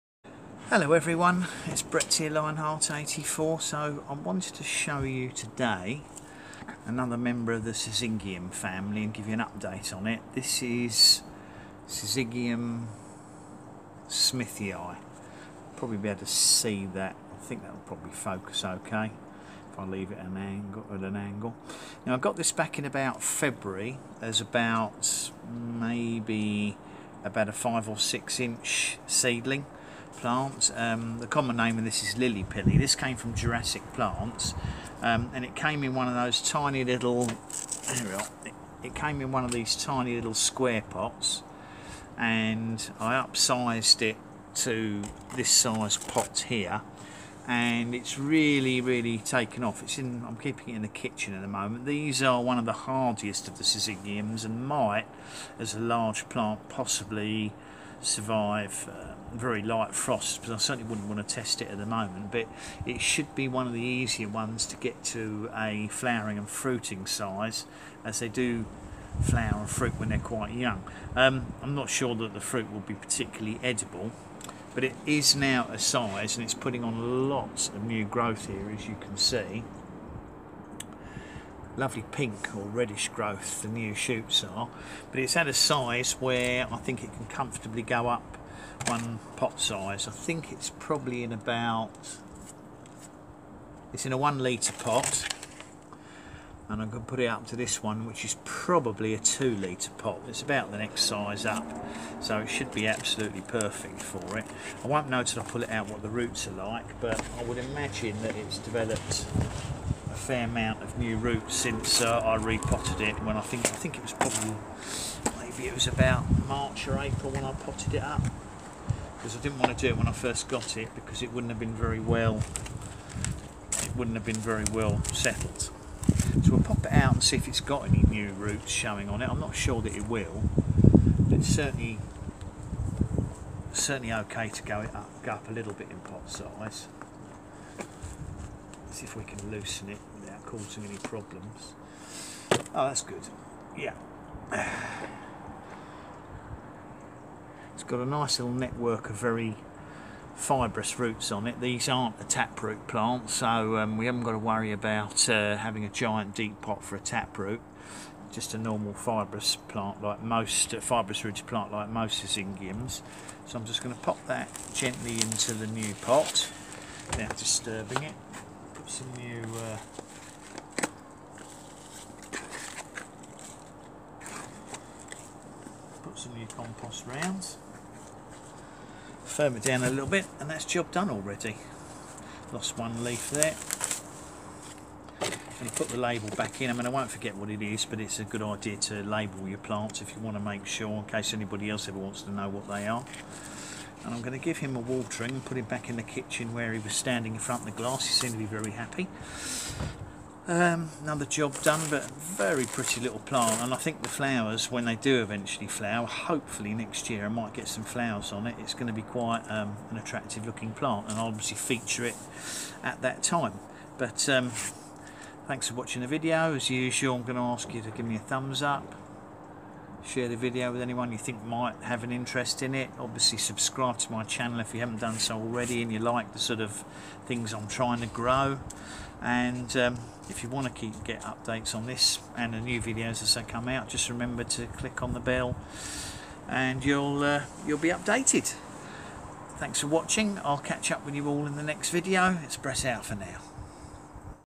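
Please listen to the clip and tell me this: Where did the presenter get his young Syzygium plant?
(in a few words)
Jurassic Plants.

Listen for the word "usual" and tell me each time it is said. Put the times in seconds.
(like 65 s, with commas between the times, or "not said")
216 s.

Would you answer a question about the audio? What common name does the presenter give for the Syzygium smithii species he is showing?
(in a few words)
lily pilly.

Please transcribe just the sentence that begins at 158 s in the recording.
Just a normal fibrous plant like most, uh, fibrous rooted plant like most Syzygiums.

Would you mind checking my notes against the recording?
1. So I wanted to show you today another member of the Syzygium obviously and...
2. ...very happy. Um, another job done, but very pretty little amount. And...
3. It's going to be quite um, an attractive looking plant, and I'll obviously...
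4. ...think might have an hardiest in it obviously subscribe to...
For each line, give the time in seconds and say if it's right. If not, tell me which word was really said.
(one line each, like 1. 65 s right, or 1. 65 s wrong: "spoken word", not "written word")
1. 3 s wrong: "family", not "obviously"
2. 198 s wrong: "plant", not "amount"
3. 208 s right
4. 221 s wrong: "interest", not "hardiest".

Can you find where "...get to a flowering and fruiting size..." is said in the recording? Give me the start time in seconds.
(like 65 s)
64 s.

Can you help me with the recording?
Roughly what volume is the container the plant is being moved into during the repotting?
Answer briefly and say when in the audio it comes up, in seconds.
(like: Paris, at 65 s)
2 litres, at 99 s.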